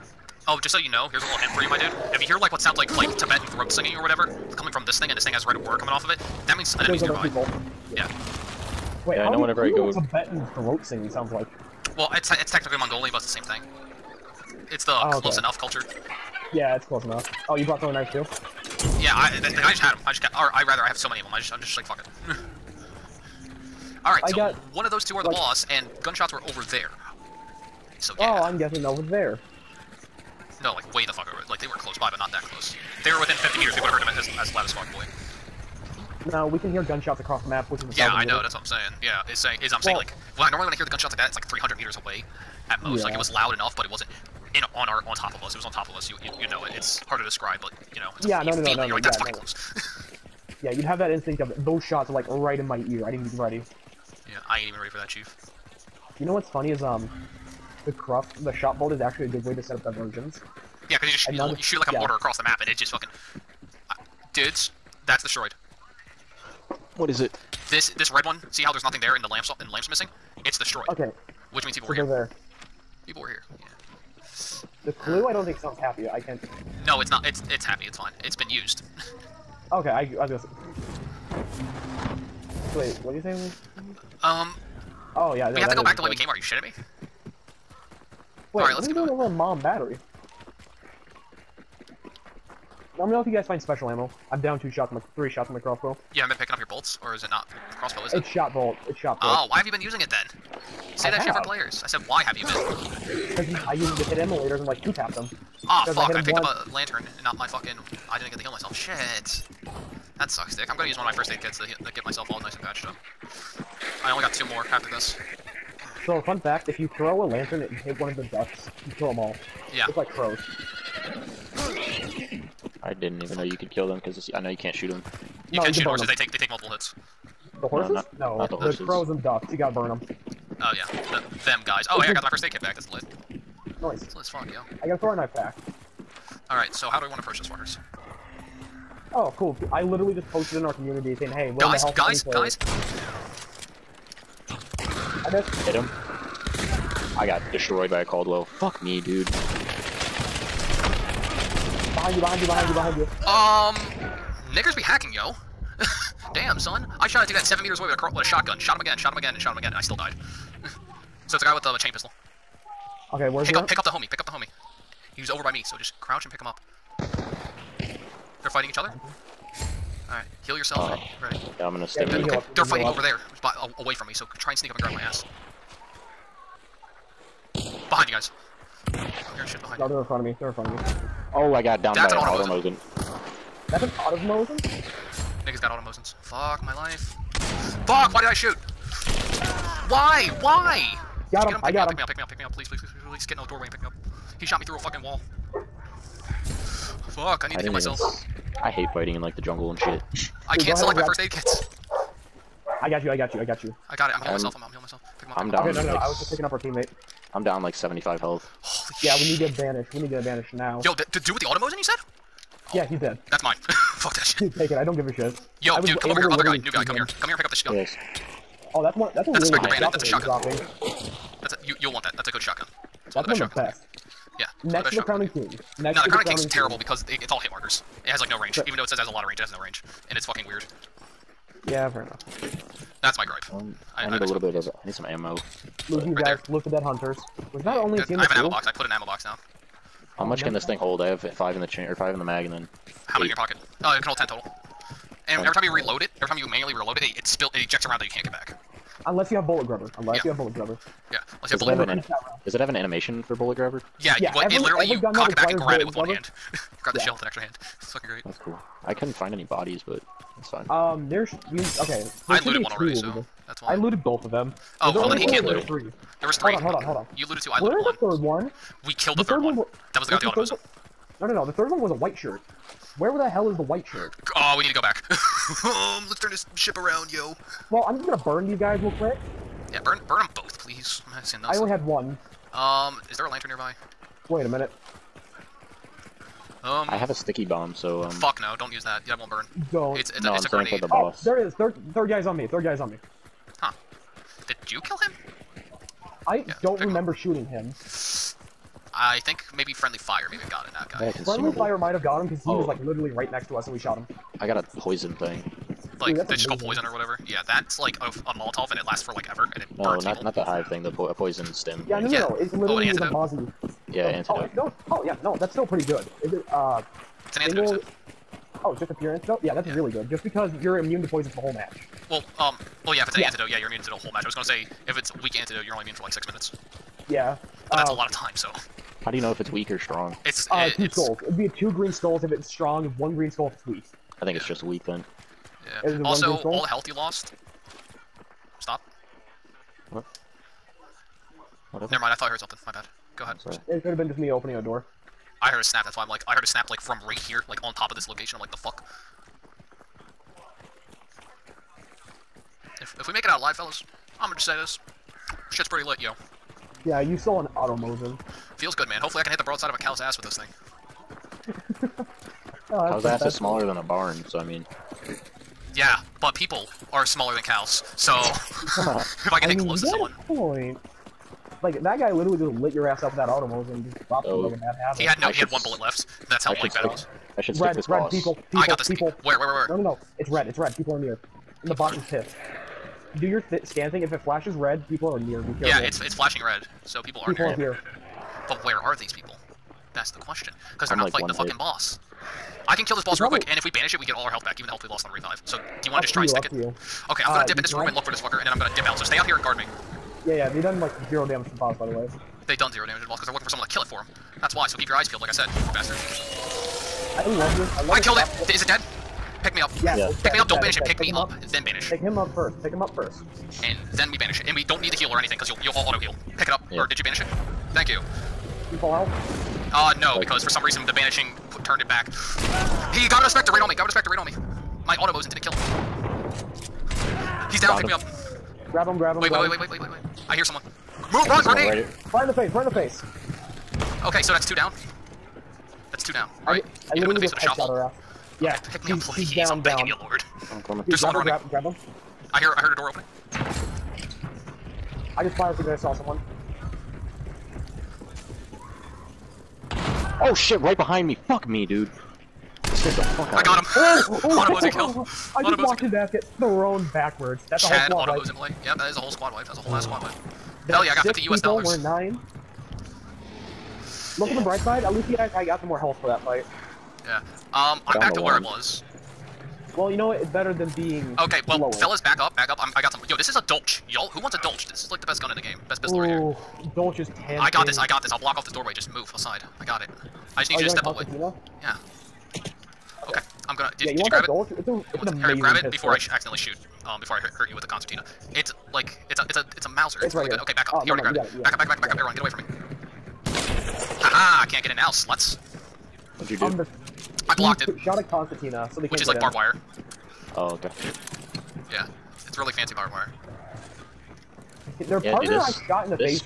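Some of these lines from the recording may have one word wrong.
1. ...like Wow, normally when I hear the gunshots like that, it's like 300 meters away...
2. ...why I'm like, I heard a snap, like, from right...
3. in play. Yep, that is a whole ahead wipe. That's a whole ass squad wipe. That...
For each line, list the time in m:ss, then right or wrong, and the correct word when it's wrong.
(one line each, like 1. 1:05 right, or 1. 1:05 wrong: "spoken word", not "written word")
1. 0:39 right
2. 5:45 right
3. 7:38 wrong: "squad", not "ahead".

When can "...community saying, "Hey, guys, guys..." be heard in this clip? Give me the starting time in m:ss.
2:20.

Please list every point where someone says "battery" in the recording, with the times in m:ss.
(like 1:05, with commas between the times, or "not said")
1:29.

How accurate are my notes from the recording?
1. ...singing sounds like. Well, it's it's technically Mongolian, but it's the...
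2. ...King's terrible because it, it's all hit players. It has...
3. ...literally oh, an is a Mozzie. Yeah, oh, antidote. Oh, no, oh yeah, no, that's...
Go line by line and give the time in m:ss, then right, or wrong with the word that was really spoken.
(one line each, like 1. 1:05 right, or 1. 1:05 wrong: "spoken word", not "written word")
1. 0:10 right
2. 3:46 wrong: "markers", not "players"
3. 5:12 right.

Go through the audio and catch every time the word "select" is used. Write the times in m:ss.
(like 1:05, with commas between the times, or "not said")
3:20.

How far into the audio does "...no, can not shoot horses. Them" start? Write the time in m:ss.
2:05.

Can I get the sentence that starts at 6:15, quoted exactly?
I he had one bullet left.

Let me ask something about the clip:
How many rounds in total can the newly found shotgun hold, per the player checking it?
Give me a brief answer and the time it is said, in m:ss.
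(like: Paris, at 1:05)
10, at 4:04.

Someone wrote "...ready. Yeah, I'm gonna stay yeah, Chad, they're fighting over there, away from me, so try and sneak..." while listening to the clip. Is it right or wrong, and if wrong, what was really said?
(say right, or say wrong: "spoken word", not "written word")
wrong: "Okay", not "Chad".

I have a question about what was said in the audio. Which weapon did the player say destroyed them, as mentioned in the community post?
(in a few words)
Caldwell.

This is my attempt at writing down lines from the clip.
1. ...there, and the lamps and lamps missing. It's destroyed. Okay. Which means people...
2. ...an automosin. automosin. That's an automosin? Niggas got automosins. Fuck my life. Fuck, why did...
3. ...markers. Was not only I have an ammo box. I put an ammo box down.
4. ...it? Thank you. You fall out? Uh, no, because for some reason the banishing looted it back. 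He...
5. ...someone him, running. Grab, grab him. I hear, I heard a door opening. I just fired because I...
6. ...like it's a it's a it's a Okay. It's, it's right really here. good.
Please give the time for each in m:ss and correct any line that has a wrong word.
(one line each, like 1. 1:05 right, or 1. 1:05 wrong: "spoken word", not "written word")
1. 1:08 right
2. 3:02 right
3. 3:56 wrong: "hunters", not "markers"
4. 6:57 wrong: "turned", not "looted"
5. 7:20 right
6. 8:08 wrong: "Mauser", not "Okay".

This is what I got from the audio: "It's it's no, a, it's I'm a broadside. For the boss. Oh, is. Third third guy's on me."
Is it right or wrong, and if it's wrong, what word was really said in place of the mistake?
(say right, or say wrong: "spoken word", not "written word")
wrong: "grenade", not "broadside".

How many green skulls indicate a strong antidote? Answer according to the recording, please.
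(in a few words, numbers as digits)
2.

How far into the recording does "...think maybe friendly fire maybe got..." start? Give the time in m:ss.
4:59.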